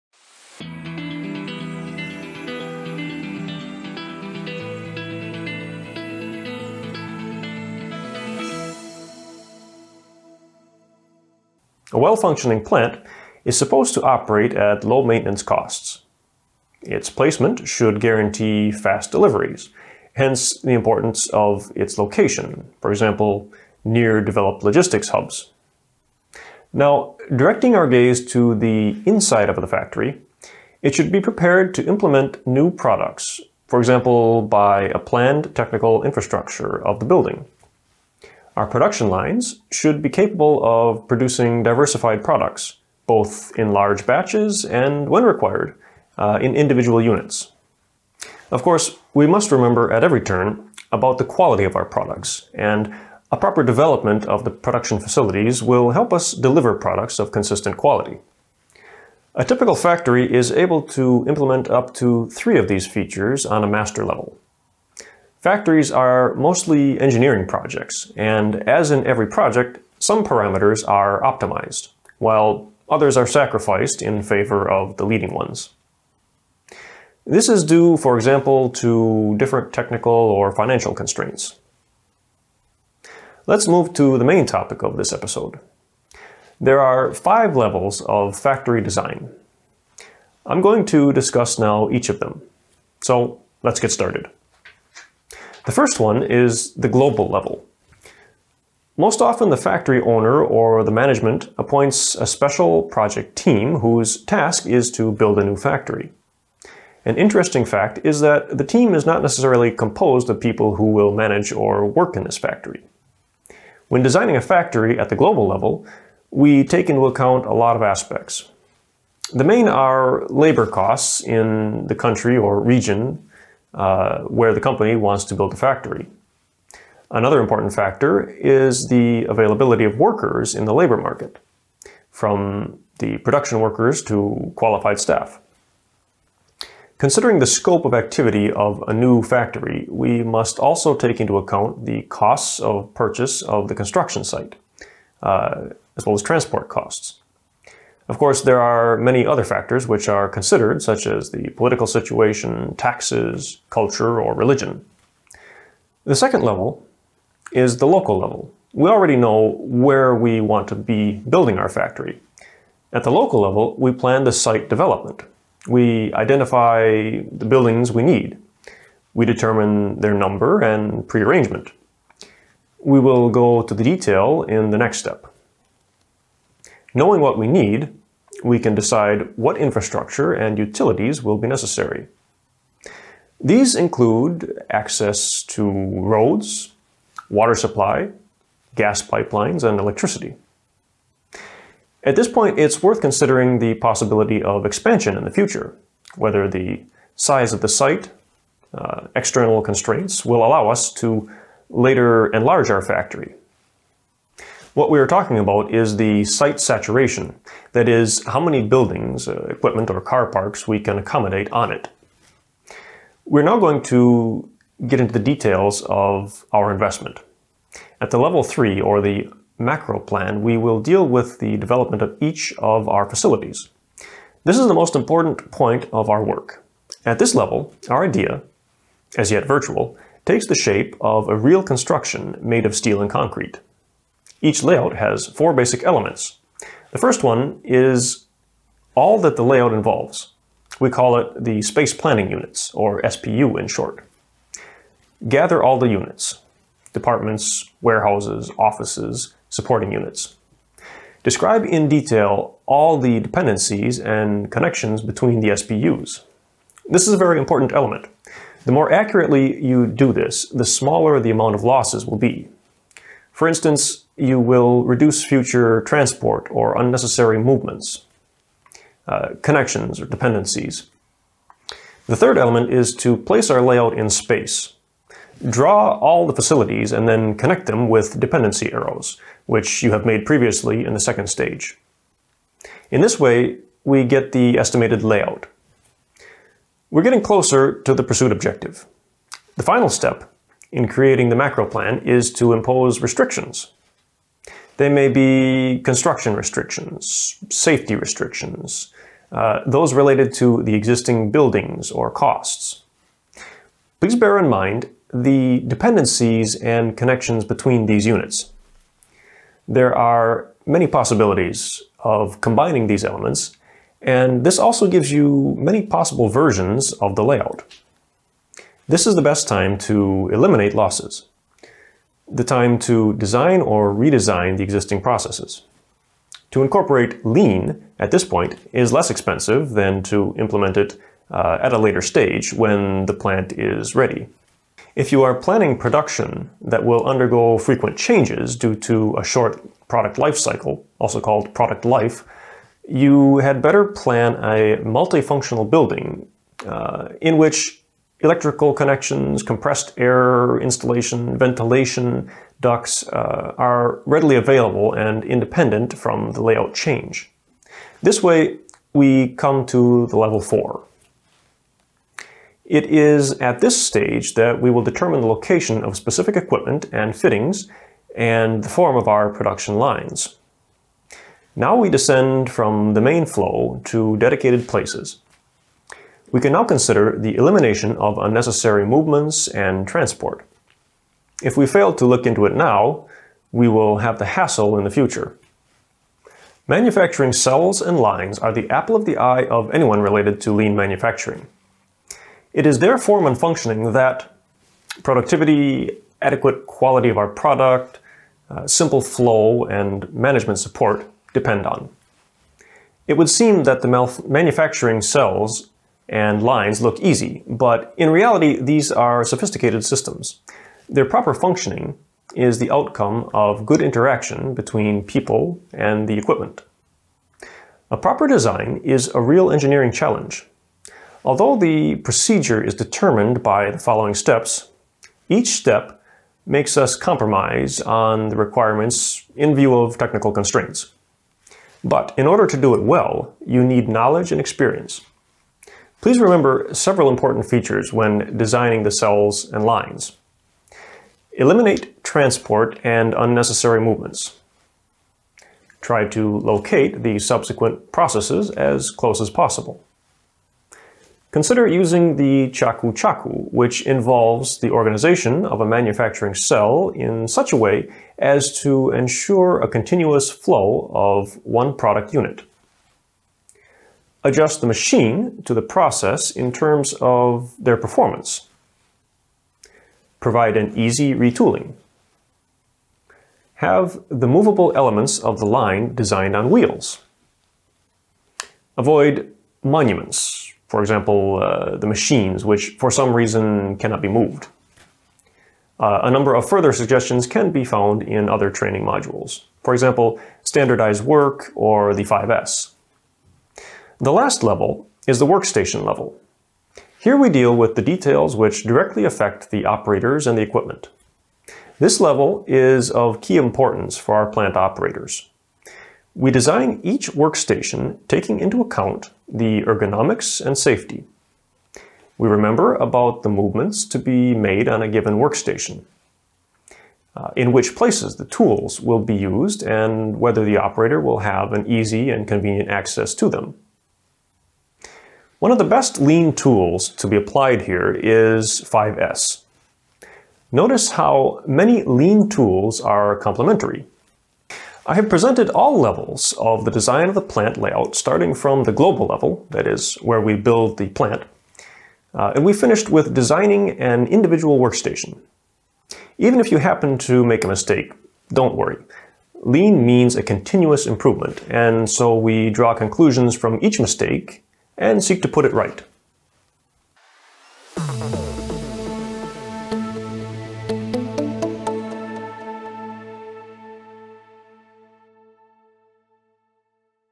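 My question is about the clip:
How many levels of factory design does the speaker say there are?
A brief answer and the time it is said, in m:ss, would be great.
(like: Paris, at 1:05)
5, at 1:27.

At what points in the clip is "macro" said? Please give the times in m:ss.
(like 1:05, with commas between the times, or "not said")
3:39, 4:51.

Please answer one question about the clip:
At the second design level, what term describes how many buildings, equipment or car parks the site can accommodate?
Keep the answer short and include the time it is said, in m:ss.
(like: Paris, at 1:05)
Site saturation, at 3:26.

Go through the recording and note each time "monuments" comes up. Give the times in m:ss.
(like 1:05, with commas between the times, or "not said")
7:59.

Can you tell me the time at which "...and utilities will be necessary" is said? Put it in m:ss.
3:00.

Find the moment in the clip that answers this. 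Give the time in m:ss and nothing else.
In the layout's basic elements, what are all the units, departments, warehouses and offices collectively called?
4:01.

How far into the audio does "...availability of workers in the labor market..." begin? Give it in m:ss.
2:09.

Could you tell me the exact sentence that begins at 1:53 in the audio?
When designing a factory at the global level, we take into account a lot of aspects.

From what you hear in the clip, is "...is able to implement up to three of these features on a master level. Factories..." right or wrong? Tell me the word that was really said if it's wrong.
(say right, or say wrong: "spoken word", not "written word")
right.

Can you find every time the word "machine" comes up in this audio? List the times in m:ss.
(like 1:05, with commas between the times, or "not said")
7:44, 8:01.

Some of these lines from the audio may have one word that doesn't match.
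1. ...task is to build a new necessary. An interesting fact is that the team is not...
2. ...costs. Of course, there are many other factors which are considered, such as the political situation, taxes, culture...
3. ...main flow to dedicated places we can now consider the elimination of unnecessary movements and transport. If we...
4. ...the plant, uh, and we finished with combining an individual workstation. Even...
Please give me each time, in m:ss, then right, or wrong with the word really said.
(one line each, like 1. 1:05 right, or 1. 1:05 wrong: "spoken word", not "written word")
1. 1:44 wrong: "factory", not "necessary"
2. 2:26 right
3. 6:13 right
4. 9:00 wrong: "designing", not "combining".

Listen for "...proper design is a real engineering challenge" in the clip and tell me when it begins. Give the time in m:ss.
6:57.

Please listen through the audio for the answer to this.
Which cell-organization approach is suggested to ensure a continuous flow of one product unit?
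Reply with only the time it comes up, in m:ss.
7:32.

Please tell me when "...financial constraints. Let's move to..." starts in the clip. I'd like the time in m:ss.
1:20.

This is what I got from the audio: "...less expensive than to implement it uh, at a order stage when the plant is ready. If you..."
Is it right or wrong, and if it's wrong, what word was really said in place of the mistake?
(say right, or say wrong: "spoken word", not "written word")
wrong: "later", not "order".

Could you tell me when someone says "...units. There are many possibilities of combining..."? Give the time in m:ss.
5:08.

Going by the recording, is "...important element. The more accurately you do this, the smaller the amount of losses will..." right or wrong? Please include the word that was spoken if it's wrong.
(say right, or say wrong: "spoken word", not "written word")
right.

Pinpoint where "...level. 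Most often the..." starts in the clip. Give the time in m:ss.
1:37.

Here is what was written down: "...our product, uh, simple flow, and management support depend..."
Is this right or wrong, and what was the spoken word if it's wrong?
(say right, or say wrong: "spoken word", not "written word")
right.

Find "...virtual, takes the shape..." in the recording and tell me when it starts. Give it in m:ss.
3:49.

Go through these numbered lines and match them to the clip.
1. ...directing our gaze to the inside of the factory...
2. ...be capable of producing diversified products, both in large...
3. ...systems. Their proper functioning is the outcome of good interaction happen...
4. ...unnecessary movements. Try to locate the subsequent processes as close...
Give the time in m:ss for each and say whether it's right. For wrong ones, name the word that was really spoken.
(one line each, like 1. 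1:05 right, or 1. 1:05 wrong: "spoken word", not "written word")
1. 0:27 right
2. 0:40 right
3. 6:49 wrong: "between", not "happen"
4. 7:23 right.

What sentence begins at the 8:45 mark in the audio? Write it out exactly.
One of the best lean tools to be applied here is 5S.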